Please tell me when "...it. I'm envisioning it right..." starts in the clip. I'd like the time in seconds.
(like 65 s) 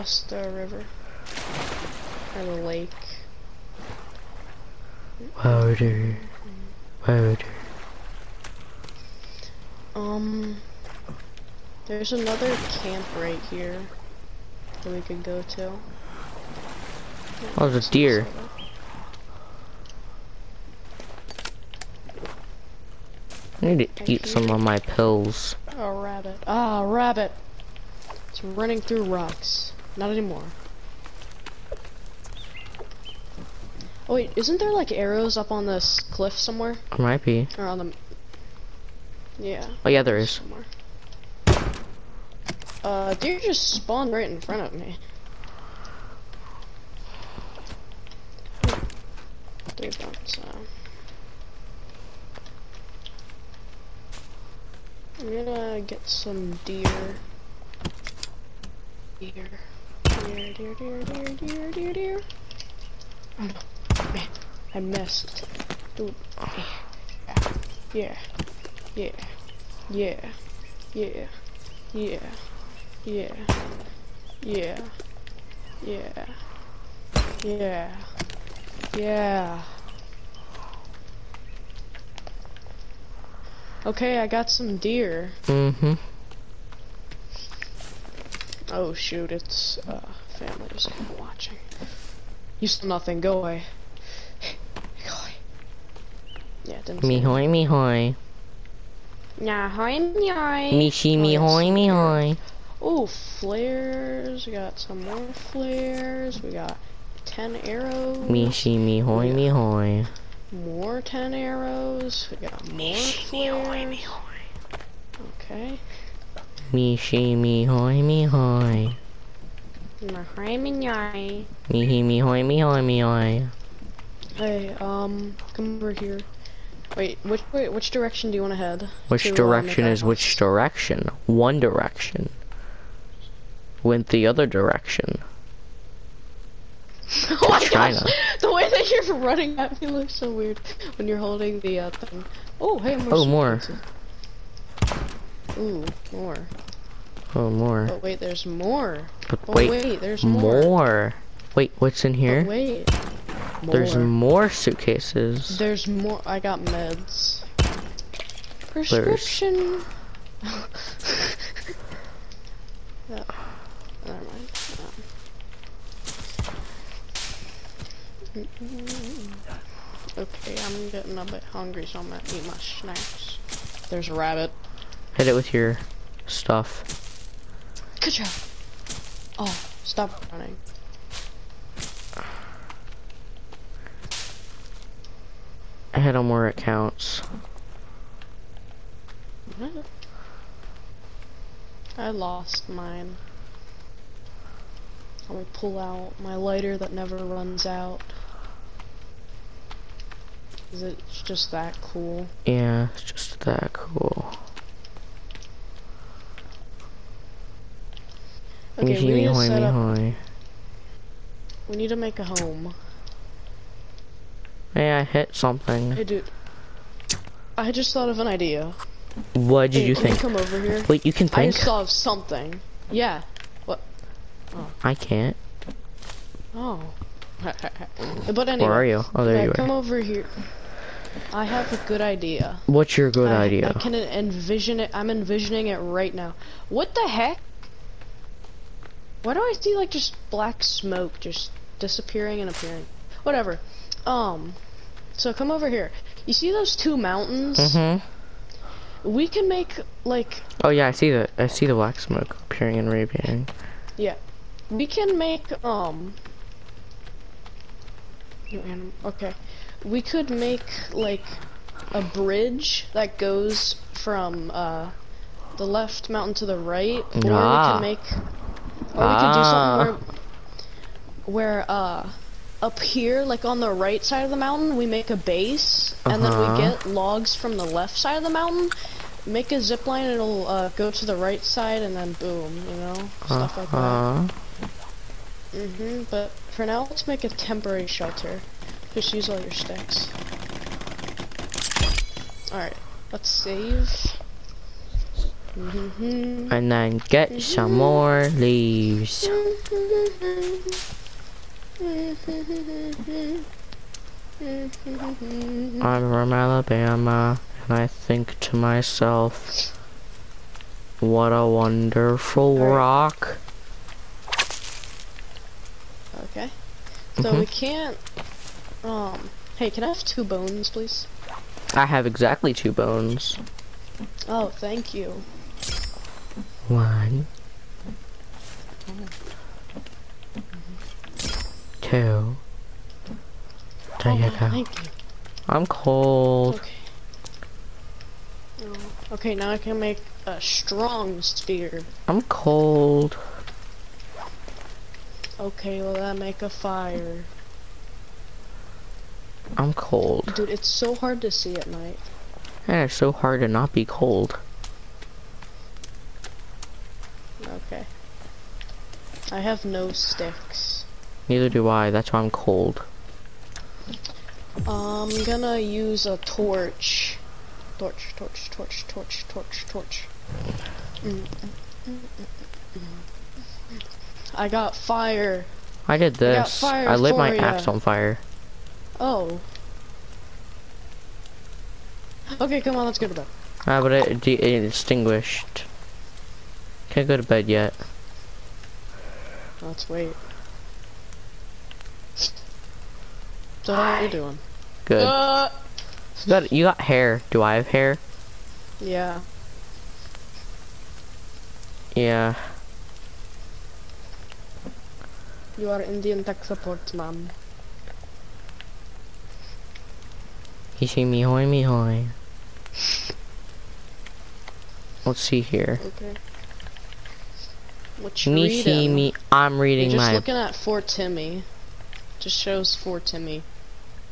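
234 s.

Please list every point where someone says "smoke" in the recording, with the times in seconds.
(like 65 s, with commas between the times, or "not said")
240 s, 251 s.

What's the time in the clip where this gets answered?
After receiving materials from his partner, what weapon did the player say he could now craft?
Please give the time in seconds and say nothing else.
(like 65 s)
340 s.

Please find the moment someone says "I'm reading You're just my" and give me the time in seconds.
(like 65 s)
419 s.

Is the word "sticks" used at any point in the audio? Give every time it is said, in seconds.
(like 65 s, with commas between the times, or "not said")
289 s, 359 s.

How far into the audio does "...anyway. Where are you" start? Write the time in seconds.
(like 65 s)
228 s.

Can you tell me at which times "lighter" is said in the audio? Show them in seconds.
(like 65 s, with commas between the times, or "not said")
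196 s.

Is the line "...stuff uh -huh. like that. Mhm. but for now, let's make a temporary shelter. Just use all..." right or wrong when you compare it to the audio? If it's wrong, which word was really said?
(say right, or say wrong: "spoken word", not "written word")
right.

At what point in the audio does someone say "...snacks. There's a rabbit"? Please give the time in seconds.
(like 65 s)
172 s.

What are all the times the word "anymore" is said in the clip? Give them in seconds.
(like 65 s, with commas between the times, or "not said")
30 s.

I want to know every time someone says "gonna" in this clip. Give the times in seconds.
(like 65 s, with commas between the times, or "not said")
55 s, 172 s, 365 s.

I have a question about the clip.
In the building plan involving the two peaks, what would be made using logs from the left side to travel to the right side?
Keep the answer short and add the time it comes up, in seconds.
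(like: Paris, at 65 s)
A zip line, at 279 s.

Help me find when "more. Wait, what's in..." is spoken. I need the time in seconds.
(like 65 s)
150 s.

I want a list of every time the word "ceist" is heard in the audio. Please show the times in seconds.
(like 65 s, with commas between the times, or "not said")
not said.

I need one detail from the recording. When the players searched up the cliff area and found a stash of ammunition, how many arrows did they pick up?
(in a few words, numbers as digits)
10.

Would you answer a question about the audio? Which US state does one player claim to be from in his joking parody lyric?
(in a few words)
Alabama.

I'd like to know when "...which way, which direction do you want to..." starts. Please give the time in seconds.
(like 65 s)
127 s.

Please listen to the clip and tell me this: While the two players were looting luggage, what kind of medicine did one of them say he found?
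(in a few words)
Prescription.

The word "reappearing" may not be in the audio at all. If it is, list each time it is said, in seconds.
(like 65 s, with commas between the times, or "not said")
252 s.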